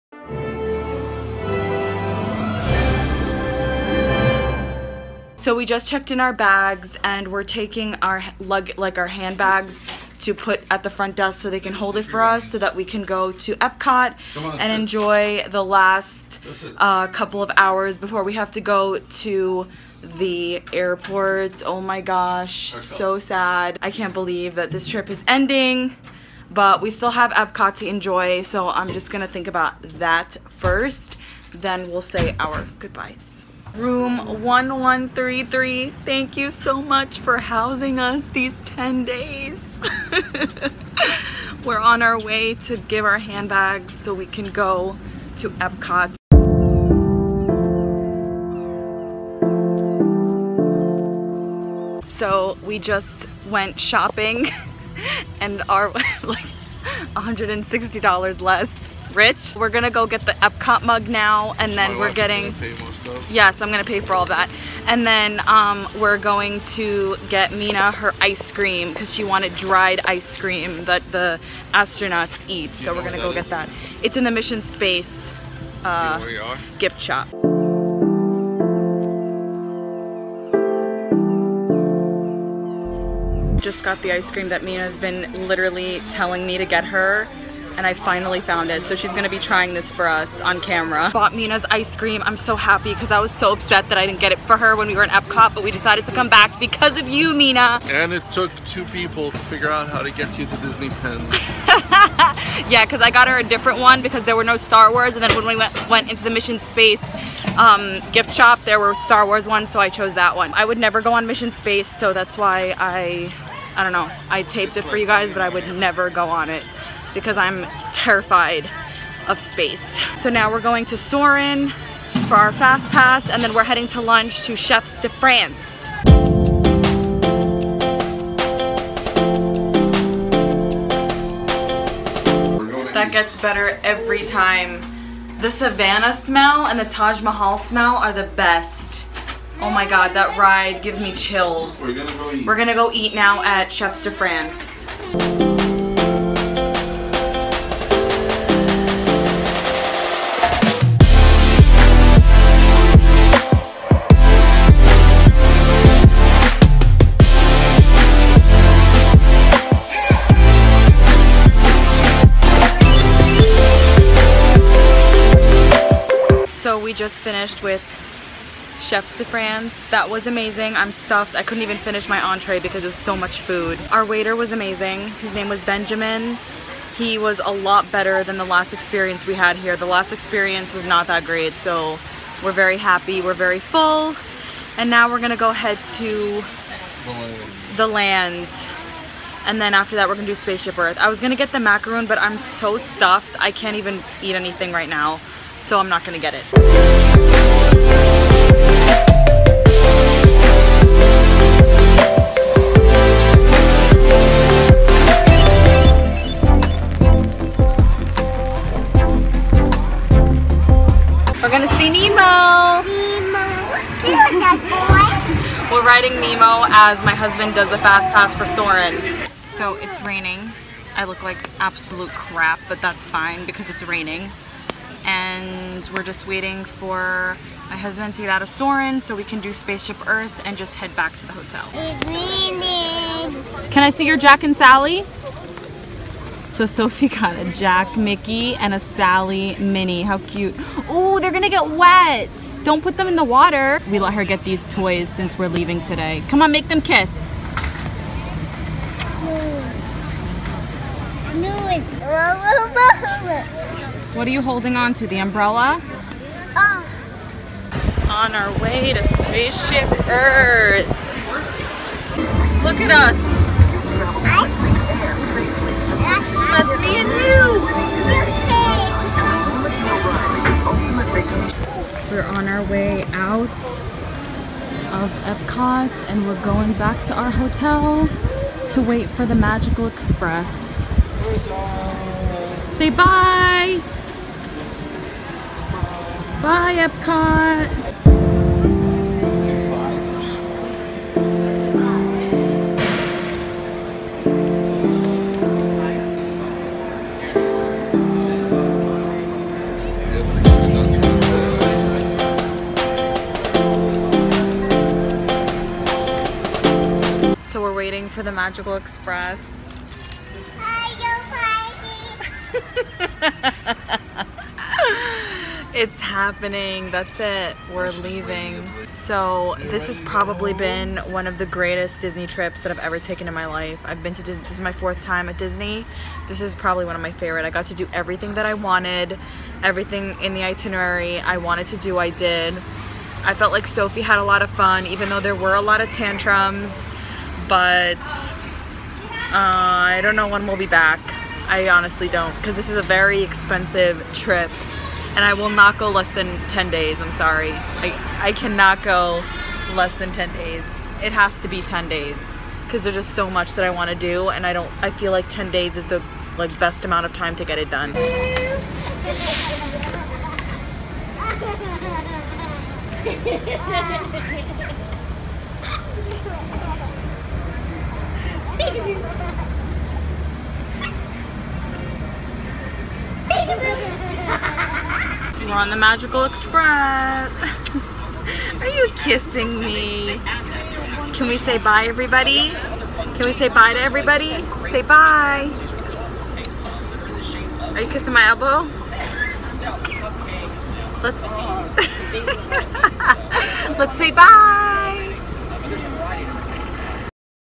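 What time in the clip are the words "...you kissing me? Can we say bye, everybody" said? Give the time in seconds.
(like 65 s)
378 s.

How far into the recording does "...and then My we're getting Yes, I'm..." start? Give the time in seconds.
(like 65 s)
61 s.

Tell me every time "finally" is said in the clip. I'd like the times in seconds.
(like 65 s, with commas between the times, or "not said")
87 s.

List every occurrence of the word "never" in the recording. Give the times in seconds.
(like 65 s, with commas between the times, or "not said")
110 s, 115 s.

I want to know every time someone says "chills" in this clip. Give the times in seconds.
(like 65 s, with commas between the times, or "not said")
141 s.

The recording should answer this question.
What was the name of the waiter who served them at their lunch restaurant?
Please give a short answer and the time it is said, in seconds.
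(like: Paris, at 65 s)
Benjamin, at 175 s.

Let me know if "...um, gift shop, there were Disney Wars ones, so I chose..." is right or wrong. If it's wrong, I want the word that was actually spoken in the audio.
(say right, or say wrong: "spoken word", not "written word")
wrong: "Star", not "Disney".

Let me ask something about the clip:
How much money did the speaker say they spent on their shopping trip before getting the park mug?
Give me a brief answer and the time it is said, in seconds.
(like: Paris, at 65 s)
$160, at 57 s.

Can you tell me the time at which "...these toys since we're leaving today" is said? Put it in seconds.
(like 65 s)
244 s.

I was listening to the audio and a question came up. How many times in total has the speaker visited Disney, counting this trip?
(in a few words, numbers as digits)
4.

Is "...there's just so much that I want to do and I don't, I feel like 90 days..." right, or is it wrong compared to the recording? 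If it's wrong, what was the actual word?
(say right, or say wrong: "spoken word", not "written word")
wrong: "10", not "90".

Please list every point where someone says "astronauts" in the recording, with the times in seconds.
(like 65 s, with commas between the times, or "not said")
71 s.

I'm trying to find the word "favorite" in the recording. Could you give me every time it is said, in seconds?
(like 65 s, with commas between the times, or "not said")
327 s.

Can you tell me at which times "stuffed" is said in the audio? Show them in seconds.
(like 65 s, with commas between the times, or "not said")
170 s, 192 s.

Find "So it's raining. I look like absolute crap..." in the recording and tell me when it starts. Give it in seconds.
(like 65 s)
219 s.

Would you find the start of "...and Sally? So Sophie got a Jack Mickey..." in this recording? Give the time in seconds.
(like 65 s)
234 s.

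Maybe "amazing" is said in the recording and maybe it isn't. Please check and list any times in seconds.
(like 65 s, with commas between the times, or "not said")
170 s, 174 s.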